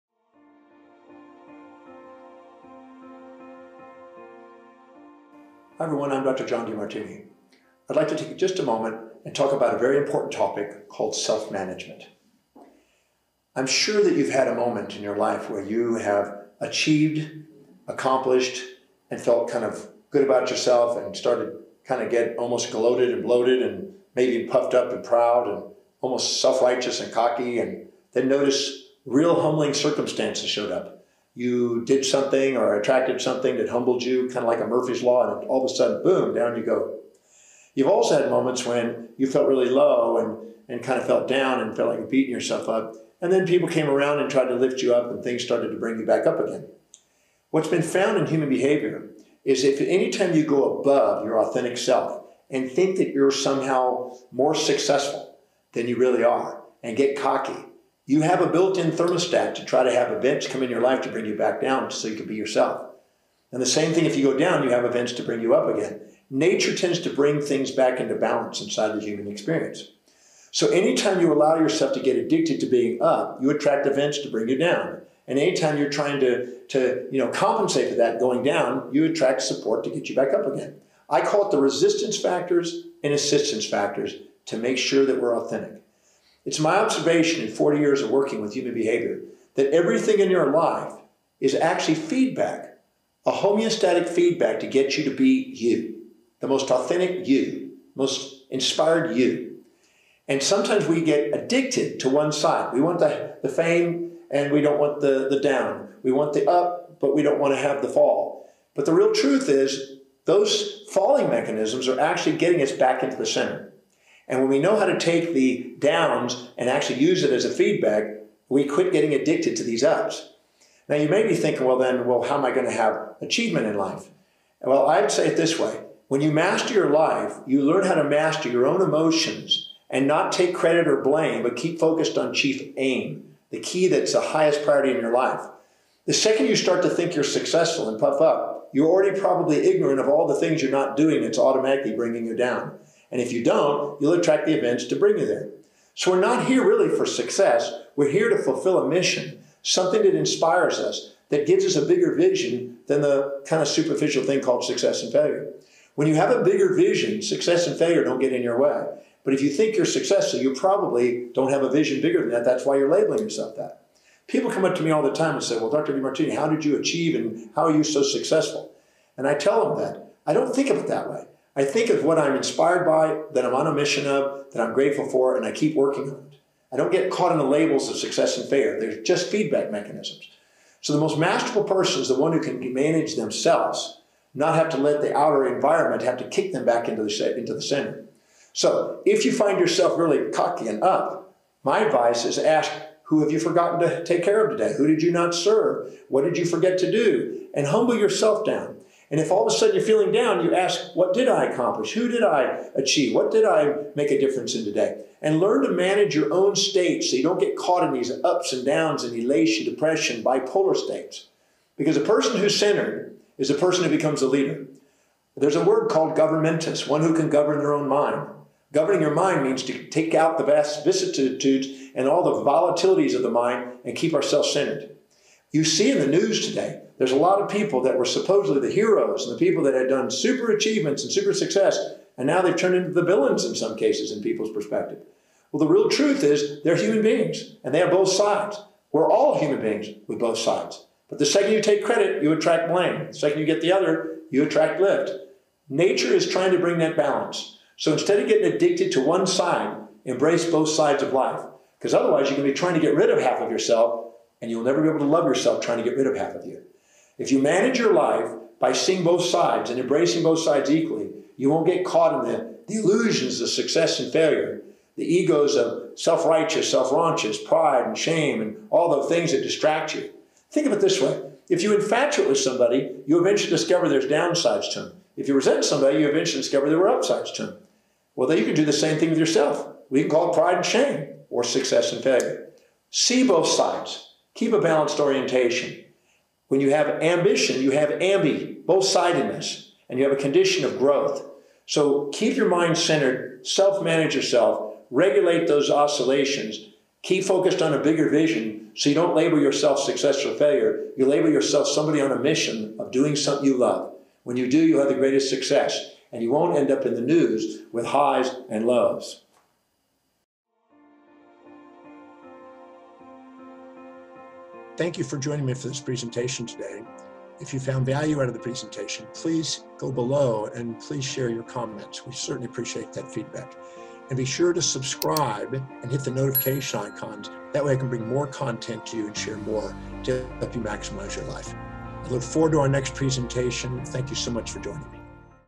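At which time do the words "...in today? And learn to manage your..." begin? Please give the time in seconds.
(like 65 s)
204 s.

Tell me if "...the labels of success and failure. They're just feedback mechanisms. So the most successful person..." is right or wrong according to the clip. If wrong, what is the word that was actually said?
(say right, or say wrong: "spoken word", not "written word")
wrong: "masterful", not "successful".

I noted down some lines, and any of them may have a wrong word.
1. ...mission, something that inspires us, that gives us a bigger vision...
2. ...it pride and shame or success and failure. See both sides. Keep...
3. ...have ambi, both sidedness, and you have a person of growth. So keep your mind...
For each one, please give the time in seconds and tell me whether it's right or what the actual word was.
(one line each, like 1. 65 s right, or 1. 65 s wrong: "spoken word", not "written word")
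1. 148 s right
2. 280 s right
3. 287 s wrong: "condition", not "person".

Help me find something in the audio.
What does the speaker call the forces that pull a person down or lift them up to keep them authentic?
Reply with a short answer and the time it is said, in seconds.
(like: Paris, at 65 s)
resistance factors and assistance factors, at 81 s.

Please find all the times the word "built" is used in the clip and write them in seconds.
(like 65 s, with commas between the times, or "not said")
58 s.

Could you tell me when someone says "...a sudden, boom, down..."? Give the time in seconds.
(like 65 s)
35 s.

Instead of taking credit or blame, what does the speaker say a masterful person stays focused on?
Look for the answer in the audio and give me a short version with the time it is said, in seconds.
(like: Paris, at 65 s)
chief aim, at 132 s.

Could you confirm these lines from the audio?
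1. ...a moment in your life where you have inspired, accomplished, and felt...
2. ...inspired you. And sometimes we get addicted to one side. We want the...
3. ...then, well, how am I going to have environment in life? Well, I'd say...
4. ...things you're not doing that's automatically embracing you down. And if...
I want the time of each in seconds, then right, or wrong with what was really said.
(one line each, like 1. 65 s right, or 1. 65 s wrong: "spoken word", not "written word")
1. 14 s wrong: "achieved", not "inspired"
2. 98 s right
3. 121 s wrong: "achievement", not "environment"
4. 140 s wrong: "bringing", not "embracing".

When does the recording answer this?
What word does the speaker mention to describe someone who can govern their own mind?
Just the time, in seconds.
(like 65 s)
216 s.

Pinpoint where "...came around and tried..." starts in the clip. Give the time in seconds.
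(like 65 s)
43 s.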